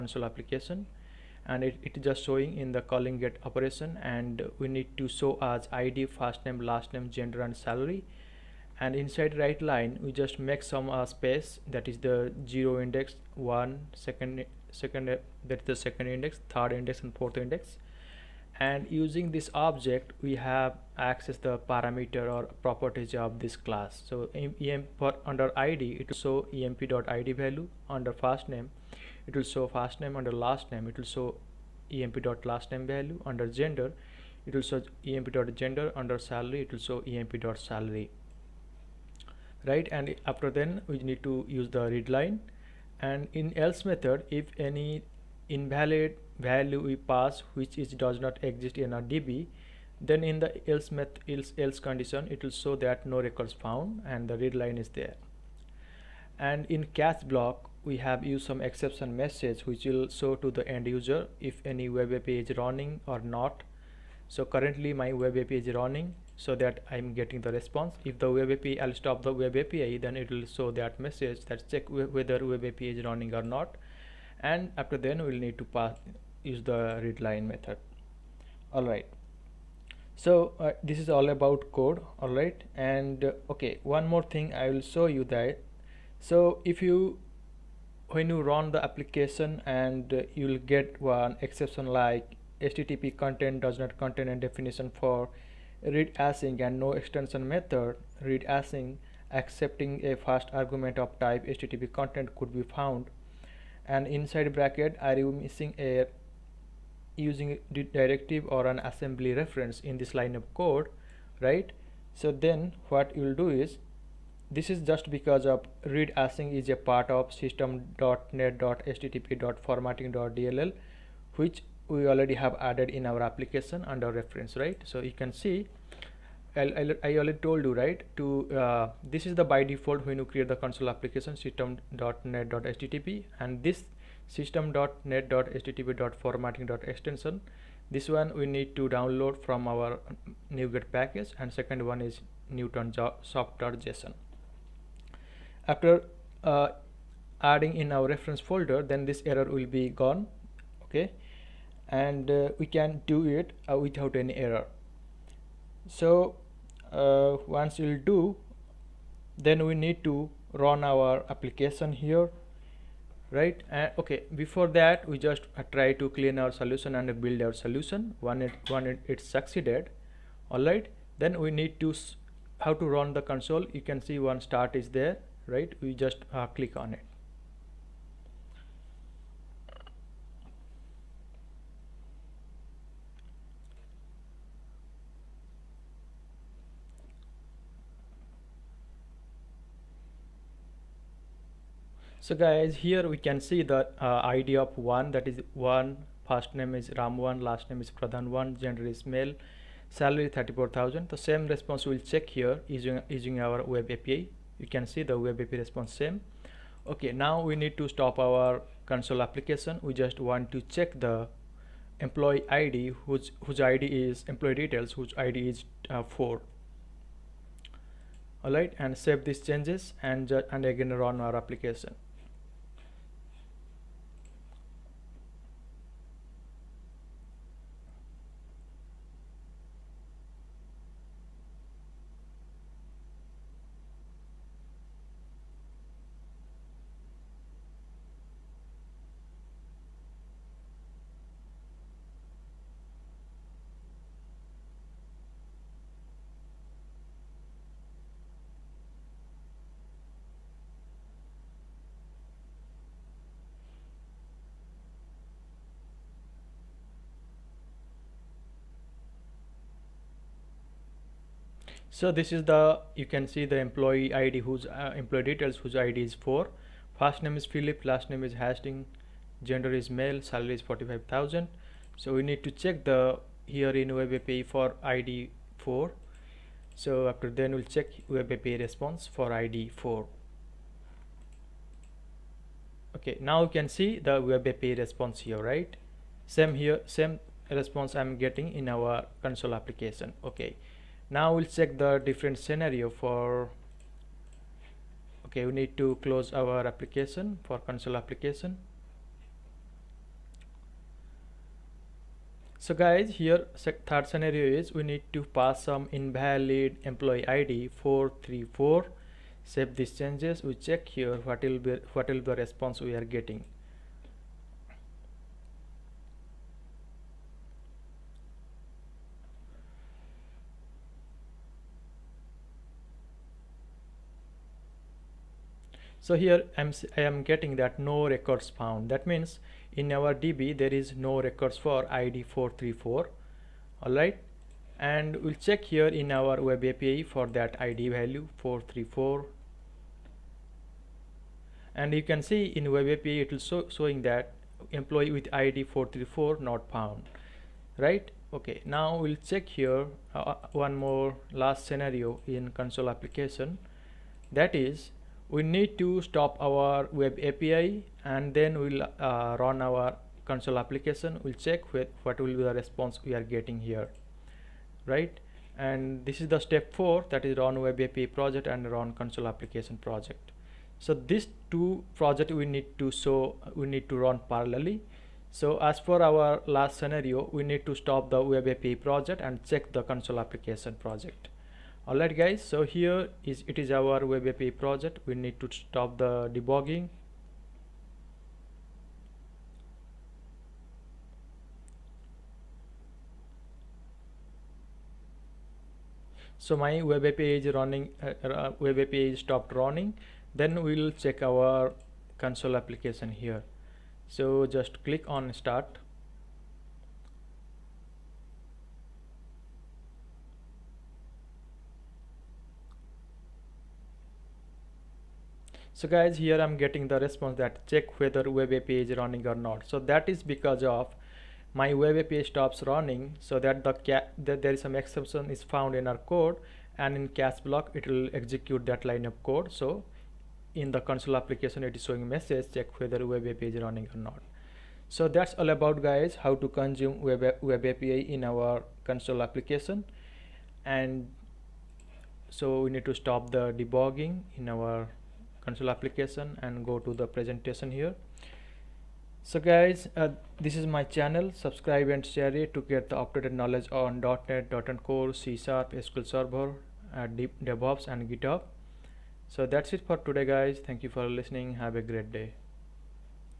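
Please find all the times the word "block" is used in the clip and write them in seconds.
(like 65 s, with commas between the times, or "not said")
57 s, 427 s.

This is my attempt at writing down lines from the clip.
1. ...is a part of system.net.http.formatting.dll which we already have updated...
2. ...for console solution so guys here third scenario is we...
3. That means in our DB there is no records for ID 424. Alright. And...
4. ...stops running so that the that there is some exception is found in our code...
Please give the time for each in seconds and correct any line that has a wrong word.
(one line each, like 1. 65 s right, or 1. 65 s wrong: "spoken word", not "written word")
1. 116 s wrong: "added", not "updated"
2. 297 s wrong: "application", not "solution"
3. 328 s wrong: "434", not "424"
4. 422 s right.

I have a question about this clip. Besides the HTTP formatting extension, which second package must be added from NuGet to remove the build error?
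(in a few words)
Newtonsoft.Json.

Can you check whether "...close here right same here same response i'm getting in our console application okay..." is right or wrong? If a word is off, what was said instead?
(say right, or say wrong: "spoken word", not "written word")
wrong: "response", not "close".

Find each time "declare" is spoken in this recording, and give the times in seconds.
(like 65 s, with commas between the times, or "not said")
not said.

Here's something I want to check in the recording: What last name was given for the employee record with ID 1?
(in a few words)
Pradhan one.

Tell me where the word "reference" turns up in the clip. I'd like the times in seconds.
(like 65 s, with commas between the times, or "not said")
109 s, 124 s, 148 s.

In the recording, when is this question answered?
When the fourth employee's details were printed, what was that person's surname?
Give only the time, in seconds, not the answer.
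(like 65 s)
268 s.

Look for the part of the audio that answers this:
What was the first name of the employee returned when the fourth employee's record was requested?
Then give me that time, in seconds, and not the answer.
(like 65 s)
267 s.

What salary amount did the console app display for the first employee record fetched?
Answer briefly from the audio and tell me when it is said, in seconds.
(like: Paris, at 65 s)
34,000, at 199 s.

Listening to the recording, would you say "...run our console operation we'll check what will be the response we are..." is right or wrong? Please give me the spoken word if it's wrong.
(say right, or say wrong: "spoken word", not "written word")
wrong: "application", not "operation".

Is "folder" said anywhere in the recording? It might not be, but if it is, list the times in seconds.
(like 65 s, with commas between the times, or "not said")
148 s.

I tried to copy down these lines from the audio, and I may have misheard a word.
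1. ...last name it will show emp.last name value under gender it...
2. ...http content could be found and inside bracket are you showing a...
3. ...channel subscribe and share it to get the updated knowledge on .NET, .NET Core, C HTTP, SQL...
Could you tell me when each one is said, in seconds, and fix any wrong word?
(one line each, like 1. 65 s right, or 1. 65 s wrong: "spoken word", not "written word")
1. 30 s right
2. 101 s wrong: "missing", not "showing"
3. 450 s wrong: "Sharp", not "HTTP".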